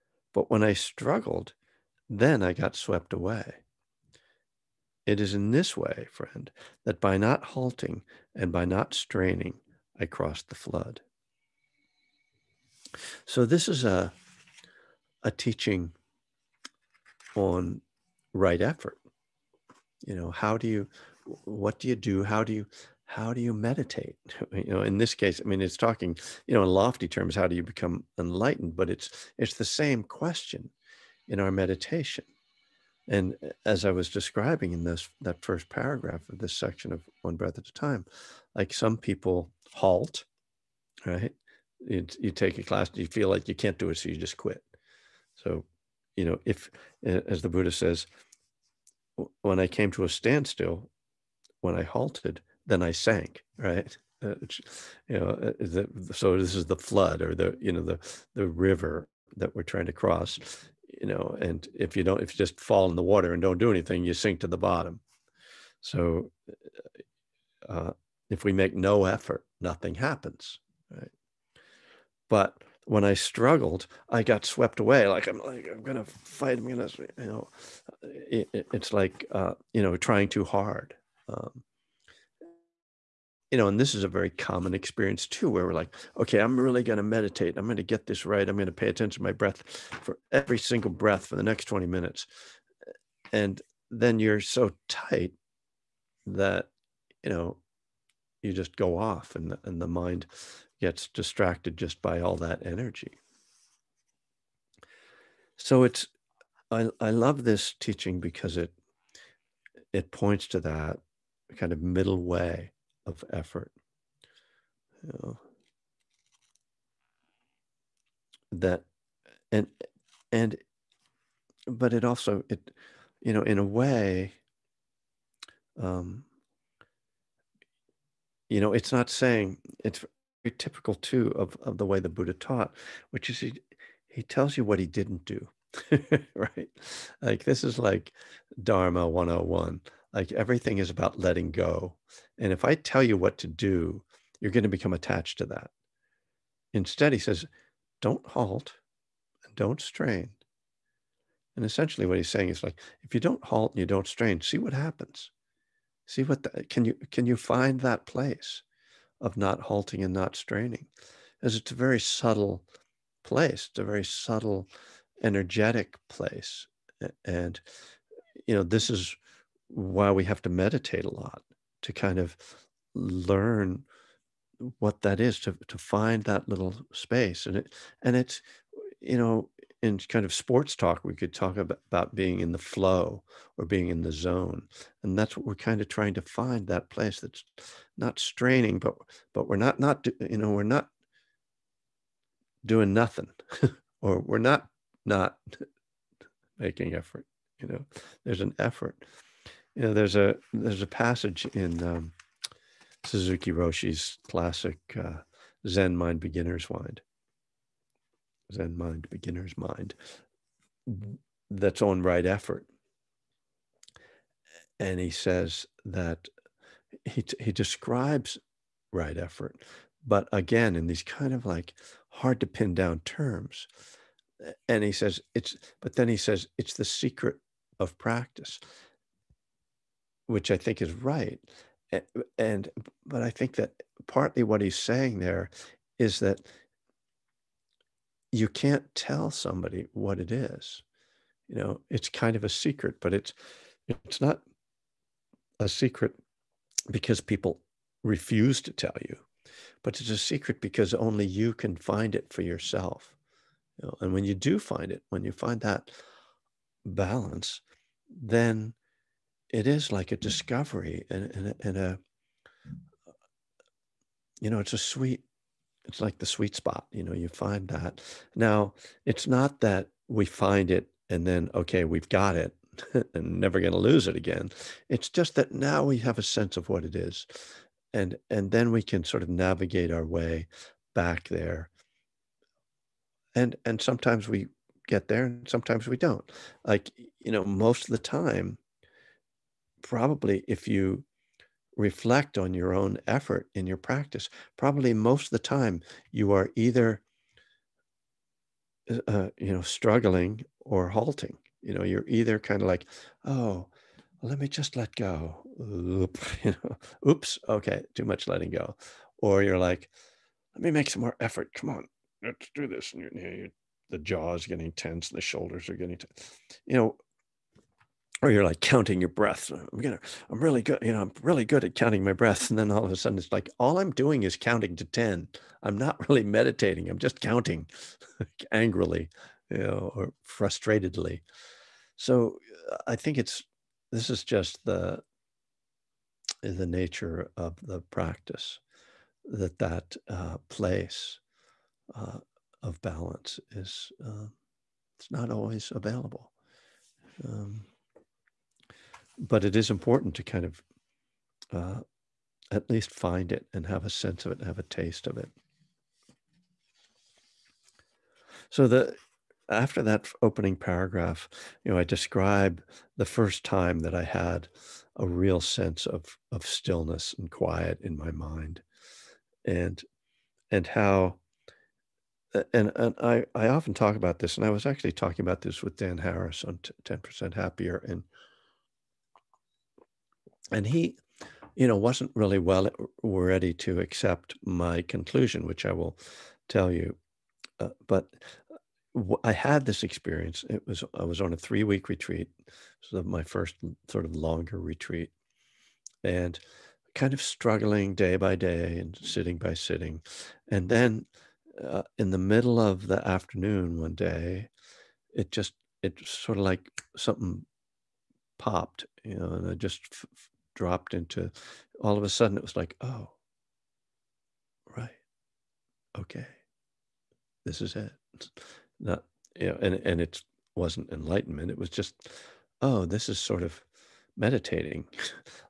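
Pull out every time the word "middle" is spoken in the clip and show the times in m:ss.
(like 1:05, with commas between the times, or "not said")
1:51, 6:42.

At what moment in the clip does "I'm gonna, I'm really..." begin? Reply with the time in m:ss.
5:19.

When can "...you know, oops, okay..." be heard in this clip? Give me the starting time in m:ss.
5:06.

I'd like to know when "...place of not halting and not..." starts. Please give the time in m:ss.
2:38.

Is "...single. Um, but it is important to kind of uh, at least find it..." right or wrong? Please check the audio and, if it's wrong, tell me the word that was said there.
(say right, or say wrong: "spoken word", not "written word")
wrong: "available", not "single".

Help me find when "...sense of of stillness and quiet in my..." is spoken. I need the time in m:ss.
6:05.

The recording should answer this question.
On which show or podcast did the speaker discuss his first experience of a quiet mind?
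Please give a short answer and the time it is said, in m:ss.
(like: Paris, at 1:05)
Ten Percent Happier, at 6:16.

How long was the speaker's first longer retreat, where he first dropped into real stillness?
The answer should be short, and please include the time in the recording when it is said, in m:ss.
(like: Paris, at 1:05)
3 weeks, at 6:31.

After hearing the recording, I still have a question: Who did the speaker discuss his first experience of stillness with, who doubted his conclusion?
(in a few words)
Dan Harris.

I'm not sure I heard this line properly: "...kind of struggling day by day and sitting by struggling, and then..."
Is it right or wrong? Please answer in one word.
wrong.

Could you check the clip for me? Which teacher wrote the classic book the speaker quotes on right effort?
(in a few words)
Suzuki Roshi.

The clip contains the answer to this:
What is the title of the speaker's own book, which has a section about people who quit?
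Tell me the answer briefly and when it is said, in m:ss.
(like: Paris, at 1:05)
One Breath at a Time, at 0:37.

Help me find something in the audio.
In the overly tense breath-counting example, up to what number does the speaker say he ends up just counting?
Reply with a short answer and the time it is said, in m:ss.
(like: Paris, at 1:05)
10, at 5:24.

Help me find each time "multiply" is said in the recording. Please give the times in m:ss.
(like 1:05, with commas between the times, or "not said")
not said.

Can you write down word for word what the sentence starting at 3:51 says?
Eh, and, but I think that partly what he's saying there is that you can't tell somebody what it is.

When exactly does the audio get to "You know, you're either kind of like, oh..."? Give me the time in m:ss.
5:01.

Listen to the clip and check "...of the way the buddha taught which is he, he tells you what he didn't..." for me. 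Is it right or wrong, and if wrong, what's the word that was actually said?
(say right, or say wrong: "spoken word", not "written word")
right.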